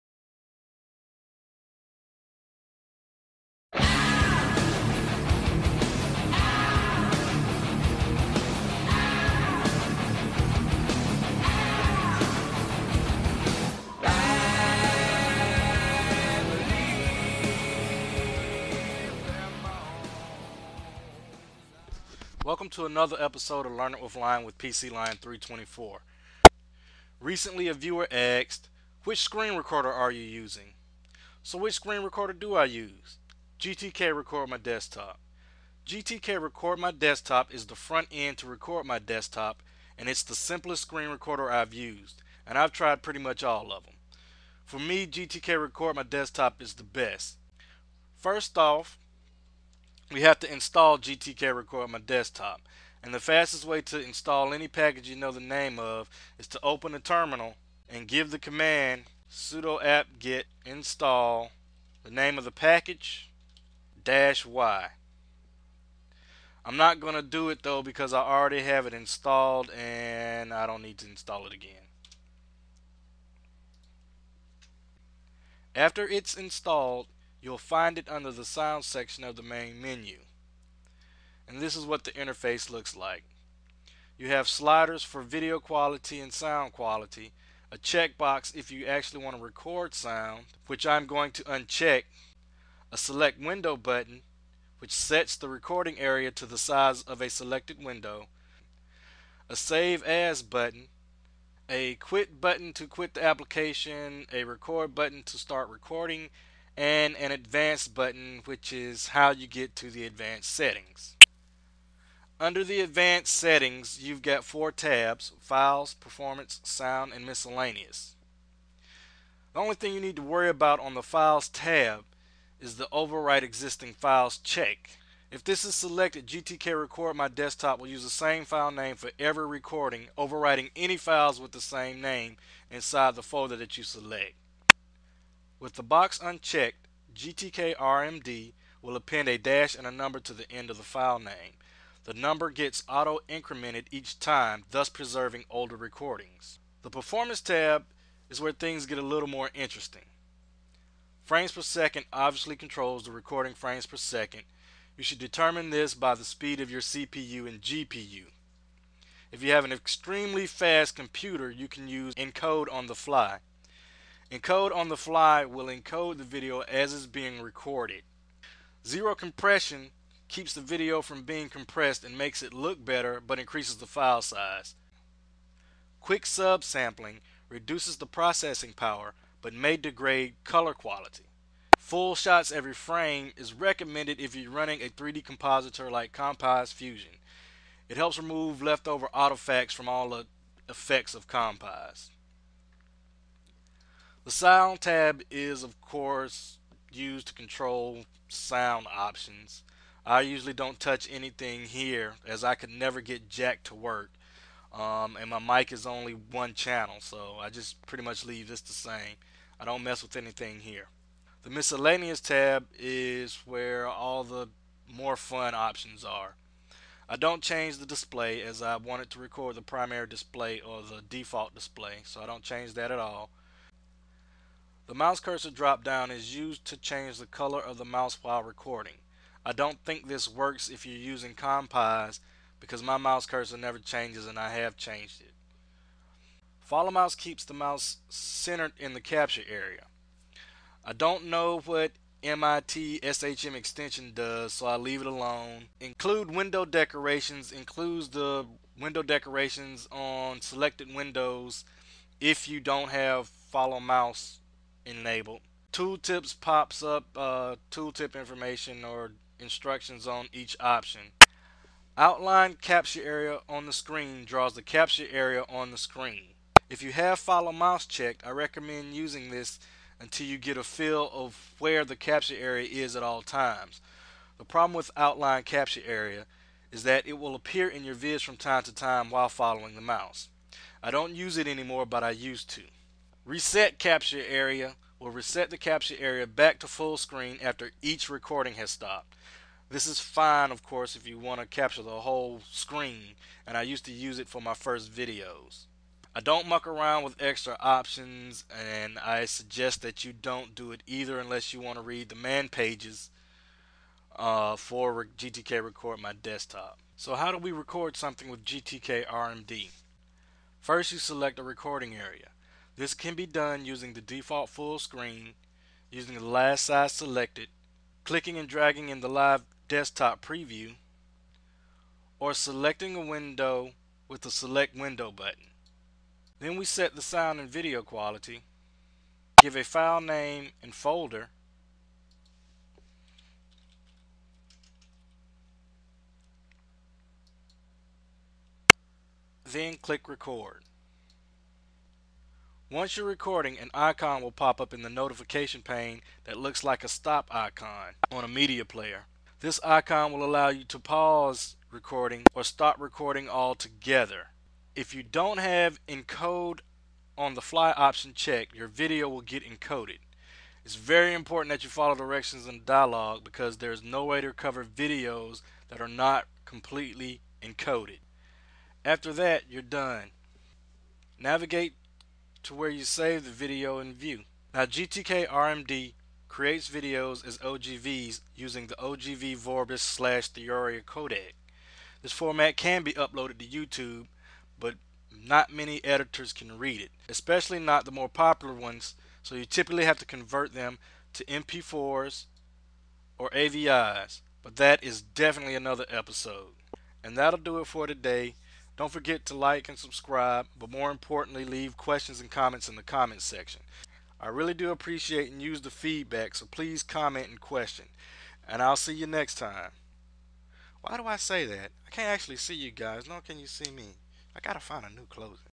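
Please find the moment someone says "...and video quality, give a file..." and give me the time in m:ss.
5:27.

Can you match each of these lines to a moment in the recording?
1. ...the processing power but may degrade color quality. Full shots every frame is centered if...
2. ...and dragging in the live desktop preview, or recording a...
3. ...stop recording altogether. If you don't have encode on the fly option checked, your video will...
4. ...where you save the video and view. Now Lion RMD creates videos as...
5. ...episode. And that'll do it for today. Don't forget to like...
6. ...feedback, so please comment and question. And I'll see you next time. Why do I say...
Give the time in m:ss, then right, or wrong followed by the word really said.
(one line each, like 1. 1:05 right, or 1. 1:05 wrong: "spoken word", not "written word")
1. 2:57 wrong: "recommended", not "centered"
2. 5:18 wrong: "selecting", not "recording"
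3. 5:52 right
4. 6:12 wrong: "GTK", not "Lion"
5. 6:35 right
6. 6:45 right.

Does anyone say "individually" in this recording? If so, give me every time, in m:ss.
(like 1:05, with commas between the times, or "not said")
not said.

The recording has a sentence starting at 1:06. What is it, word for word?
I'm not going to do it though because I already have it installed and I don't need to install it again.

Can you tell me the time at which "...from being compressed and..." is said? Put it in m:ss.
2:51.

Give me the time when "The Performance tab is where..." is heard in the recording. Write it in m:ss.
2:26.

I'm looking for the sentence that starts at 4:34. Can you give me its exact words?
The problem with outline capture area is that it will appear in your vids from time to time while following the mouse.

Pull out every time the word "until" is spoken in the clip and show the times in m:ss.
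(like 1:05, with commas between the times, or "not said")
4:29.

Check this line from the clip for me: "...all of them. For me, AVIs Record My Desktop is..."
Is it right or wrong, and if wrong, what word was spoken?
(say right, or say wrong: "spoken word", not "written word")
wrong: "GTK", not "AVIs".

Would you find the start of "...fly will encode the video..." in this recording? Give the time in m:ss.
2:44.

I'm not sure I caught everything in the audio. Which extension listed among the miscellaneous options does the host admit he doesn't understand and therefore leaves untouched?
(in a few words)
MIT SHM.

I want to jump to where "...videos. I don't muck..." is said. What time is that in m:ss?
4:54.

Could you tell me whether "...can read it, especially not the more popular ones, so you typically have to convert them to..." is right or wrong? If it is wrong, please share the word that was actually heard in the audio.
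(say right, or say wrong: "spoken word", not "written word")
right.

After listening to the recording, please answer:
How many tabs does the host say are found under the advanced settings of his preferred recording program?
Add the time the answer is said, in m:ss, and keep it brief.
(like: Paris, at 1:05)
4, at 1:54.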